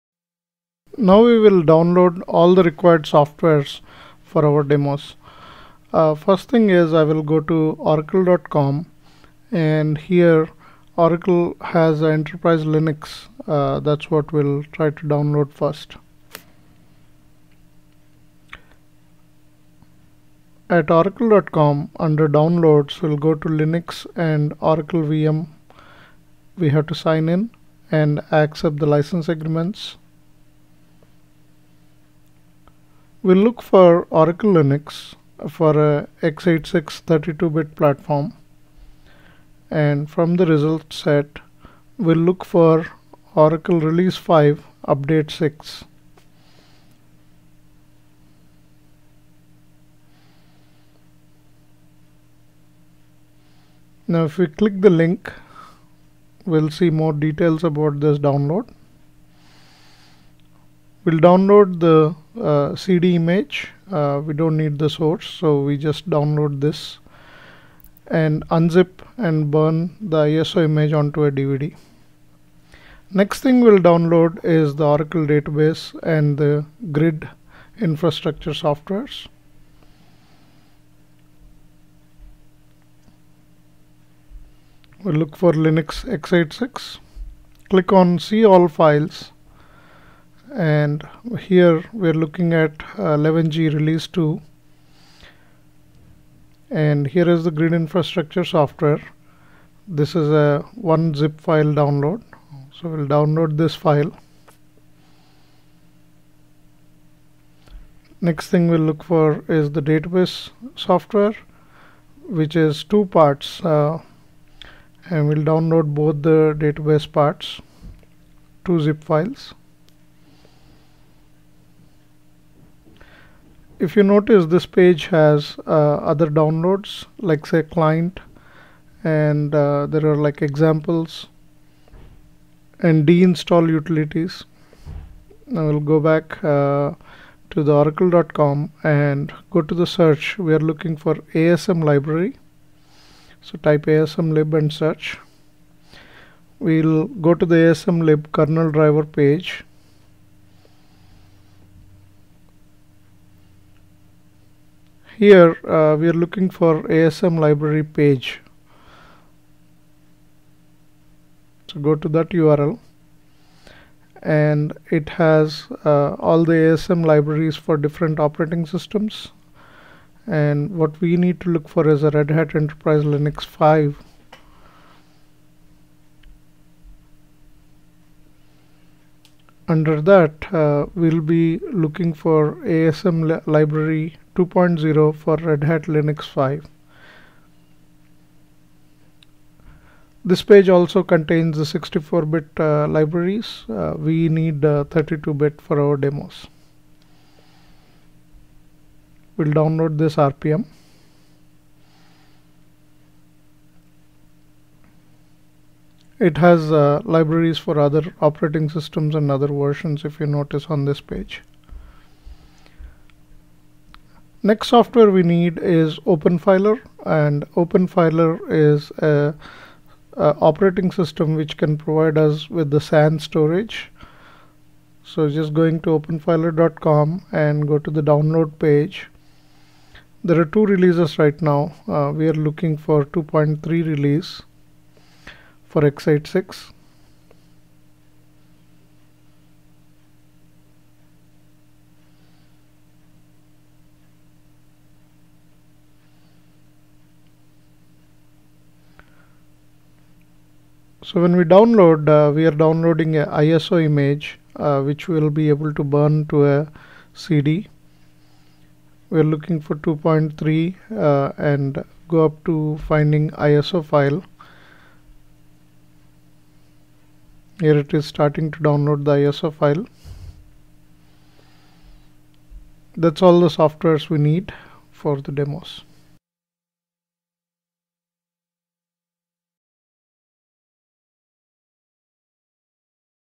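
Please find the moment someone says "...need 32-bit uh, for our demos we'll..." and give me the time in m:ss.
3:14.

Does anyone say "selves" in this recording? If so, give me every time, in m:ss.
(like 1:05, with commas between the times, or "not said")
not said.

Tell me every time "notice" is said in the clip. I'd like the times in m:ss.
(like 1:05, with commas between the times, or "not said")
2:04, 3:30.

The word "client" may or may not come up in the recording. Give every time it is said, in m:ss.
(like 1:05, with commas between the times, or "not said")
2:07.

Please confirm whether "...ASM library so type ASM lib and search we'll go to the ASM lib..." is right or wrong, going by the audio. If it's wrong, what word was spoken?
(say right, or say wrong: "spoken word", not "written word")
right.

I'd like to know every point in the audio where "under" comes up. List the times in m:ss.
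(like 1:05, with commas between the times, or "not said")
0:21, 2:59.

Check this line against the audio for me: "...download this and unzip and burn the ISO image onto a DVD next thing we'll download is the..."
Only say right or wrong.
right.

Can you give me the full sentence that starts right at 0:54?
Now if we click the link we'll see more details about this download.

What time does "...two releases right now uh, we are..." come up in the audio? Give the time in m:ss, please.
3:50.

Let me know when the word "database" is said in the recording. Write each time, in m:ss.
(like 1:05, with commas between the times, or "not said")
1:15, 1:49, 1:56.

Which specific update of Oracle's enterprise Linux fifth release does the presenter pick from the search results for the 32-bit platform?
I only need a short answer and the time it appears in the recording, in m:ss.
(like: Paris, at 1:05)
Update 6, at 0:44.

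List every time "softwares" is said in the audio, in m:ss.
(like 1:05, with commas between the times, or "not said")
0:03, 1:18, 1:38, 1:50, 3:34, 4:33.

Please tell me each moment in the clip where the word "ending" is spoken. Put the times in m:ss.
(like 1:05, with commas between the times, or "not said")
not said.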